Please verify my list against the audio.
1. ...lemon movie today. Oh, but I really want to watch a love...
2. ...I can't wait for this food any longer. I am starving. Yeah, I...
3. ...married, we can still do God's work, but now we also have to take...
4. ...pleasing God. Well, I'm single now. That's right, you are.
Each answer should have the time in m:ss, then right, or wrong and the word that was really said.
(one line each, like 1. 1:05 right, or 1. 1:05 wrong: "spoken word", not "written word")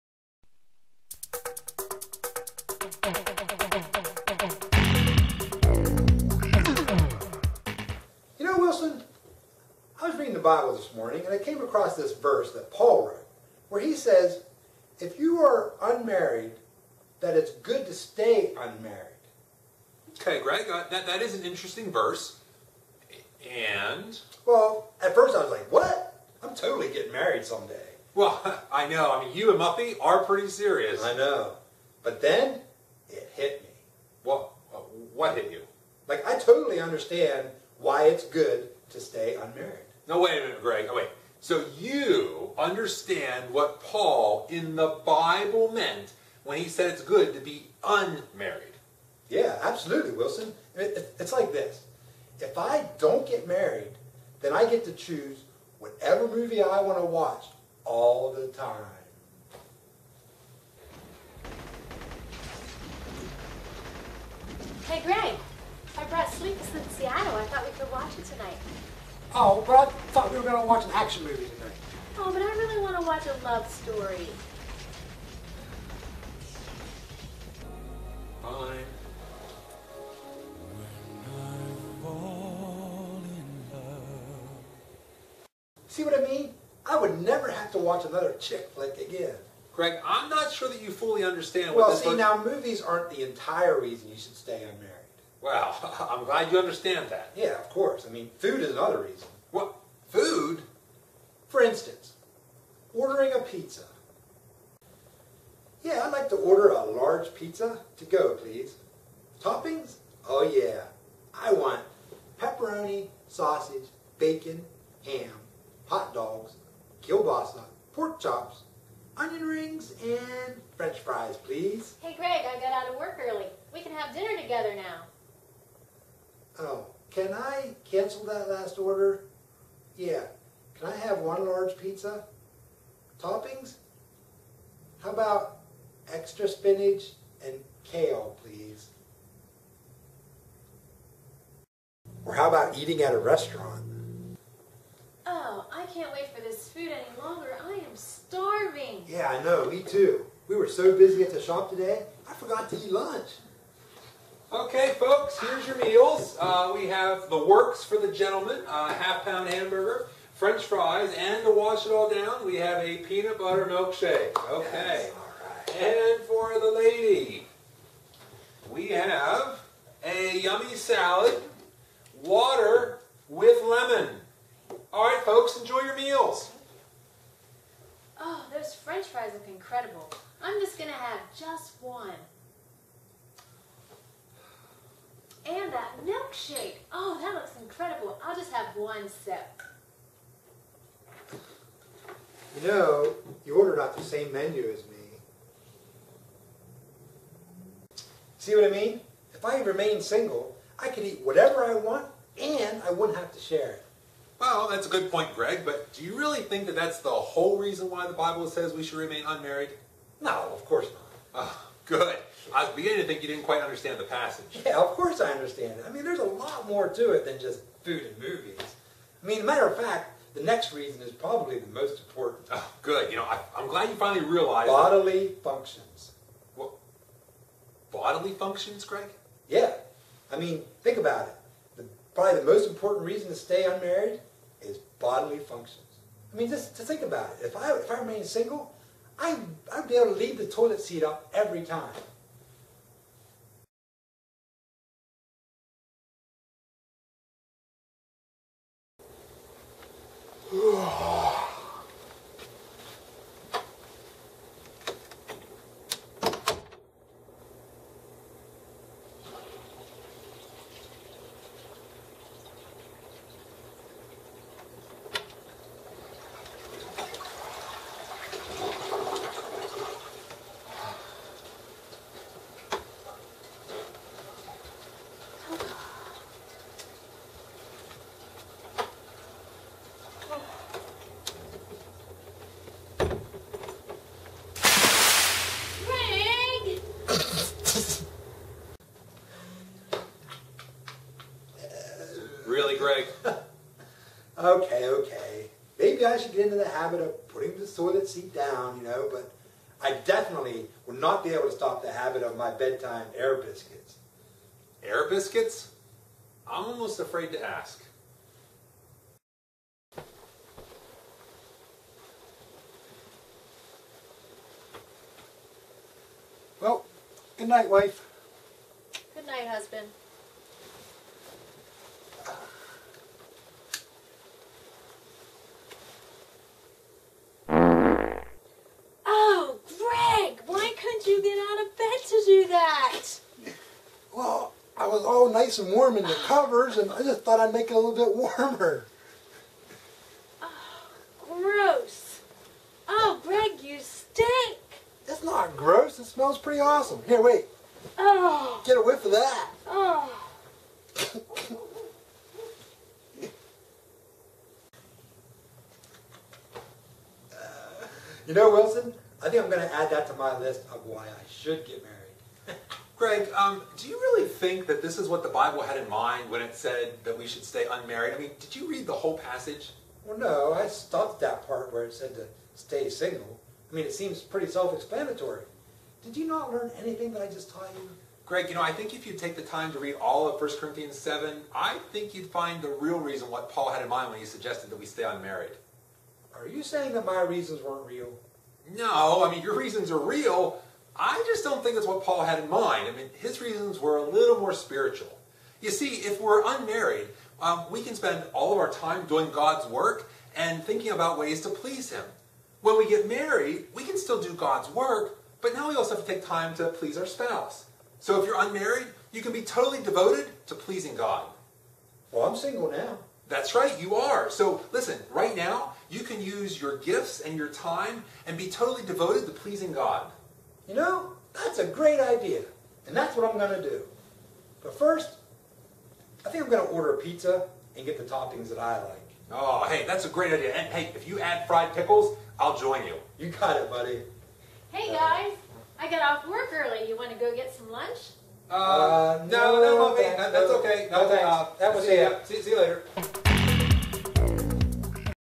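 1. 1:10 wrong: "action", not "lemon"
2. 2:25 right
3. 6:43 right
4. 6:50 right.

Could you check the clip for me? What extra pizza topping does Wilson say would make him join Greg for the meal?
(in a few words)
fried pickles.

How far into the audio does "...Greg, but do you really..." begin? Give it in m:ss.
3:25.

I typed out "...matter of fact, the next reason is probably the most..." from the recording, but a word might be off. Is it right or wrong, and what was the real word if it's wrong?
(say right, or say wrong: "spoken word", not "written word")
right.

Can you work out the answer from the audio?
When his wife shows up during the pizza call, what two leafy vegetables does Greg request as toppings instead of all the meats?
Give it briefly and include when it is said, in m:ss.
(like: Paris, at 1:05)
spinach and kale, at 2:16.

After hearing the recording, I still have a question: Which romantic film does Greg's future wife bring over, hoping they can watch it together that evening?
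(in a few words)
Sleepless in Seattle.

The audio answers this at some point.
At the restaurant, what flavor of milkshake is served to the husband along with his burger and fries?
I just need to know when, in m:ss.
2:42.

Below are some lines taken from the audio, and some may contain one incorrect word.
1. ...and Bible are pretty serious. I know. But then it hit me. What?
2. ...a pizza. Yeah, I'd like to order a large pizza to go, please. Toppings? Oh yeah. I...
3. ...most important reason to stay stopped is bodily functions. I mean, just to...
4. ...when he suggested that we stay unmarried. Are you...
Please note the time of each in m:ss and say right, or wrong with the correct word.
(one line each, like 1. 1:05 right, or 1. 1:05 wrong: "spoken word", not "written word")
1. 0:29 wrong: "Muffy", not "Bible"
2. 1:43 right
3. 3:52 wrong: "unmarried", not "stopped"
4. 6:24 right.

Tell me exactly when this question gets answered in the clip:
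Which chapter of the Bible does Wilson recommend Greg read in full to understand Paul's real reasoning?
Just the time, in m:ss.
6:20.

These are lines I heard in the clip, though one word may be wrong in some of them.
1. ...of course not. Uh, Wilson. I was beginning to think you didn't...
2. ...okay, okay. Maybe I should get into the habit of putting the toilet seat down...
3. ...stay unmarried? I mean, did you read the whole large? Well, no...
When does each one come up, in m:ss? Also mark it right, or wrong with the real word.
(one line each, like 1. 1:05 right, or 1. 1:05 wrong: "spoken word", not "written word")
1. 3:30 wrong: "Good", not "Wilson"
2. 4:54 right
3. 6:07 wrong: "passage", not "large".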